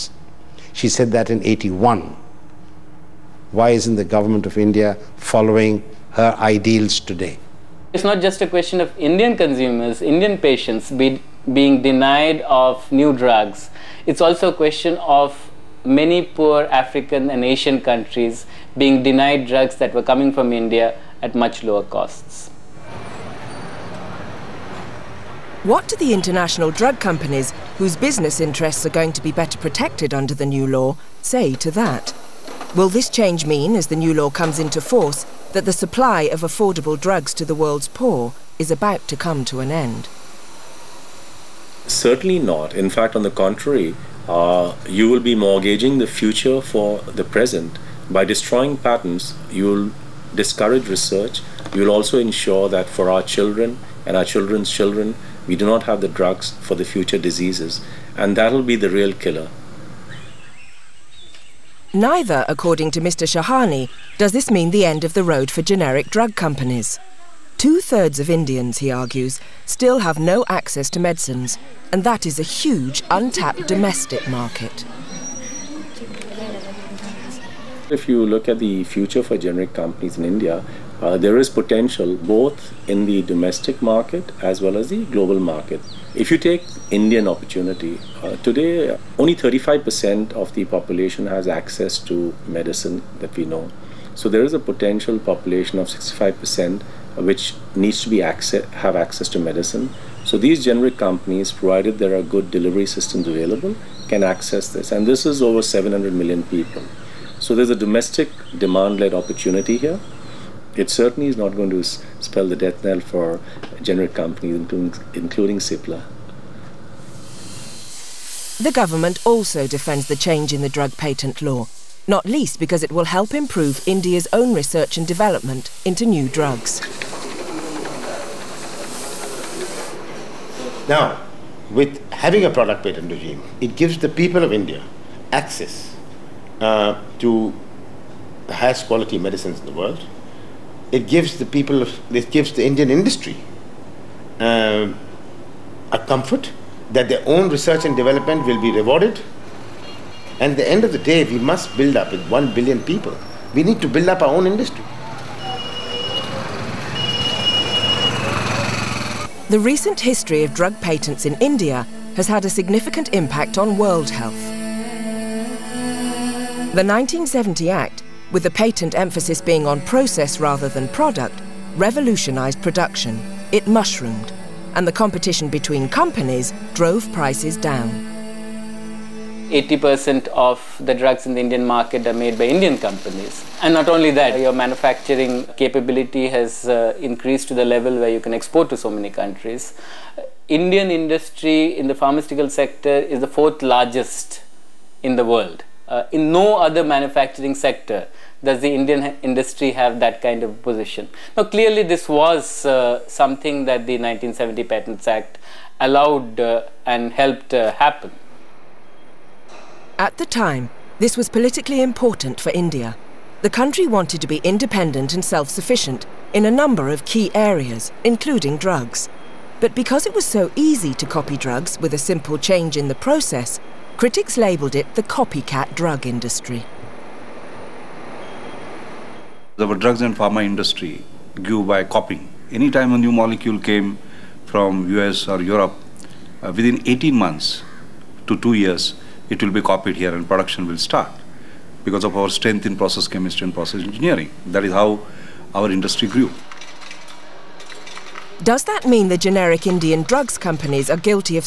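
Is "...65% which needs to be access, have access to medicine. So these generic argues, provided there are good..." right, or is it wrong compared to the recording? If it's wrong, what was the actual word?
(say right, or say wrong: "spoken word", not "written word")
wrong: "companies", not "argues".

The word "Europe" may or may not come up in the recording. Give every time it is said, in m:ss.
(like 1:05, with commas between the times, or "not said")
3:55.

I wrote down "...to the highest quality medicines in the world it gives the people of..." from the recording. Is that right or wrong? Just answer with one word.
right.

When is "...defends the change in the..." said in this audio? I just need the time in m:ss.
1:59.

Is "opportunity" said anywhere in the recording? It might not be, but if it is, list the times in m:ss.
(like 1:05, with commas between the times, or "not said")
1:27, 1:49.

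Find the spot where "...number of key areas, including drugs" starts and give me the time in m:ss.
3:36.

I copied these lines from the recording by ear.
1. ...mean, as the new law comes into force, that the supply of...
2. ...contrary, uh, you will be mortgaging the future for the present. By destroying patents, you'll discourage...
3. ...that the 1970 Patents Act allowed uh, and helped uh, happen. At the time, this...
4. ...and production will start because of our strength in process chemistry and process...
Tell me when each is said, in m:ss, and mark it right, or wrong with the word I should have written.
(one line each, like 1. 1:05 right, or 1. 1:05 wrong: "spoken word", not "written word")
1. 0:33 right
2. 0:43 right
3. 3:23 right
4. 4:00 right.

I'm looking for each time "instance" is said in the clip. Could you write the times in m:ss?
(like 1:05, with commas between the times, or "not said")
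not said.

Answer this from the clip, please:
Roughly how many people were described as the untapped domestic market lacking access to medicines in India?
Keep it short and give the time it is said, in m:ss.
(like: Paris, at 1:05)
over 700 million, at 1:45.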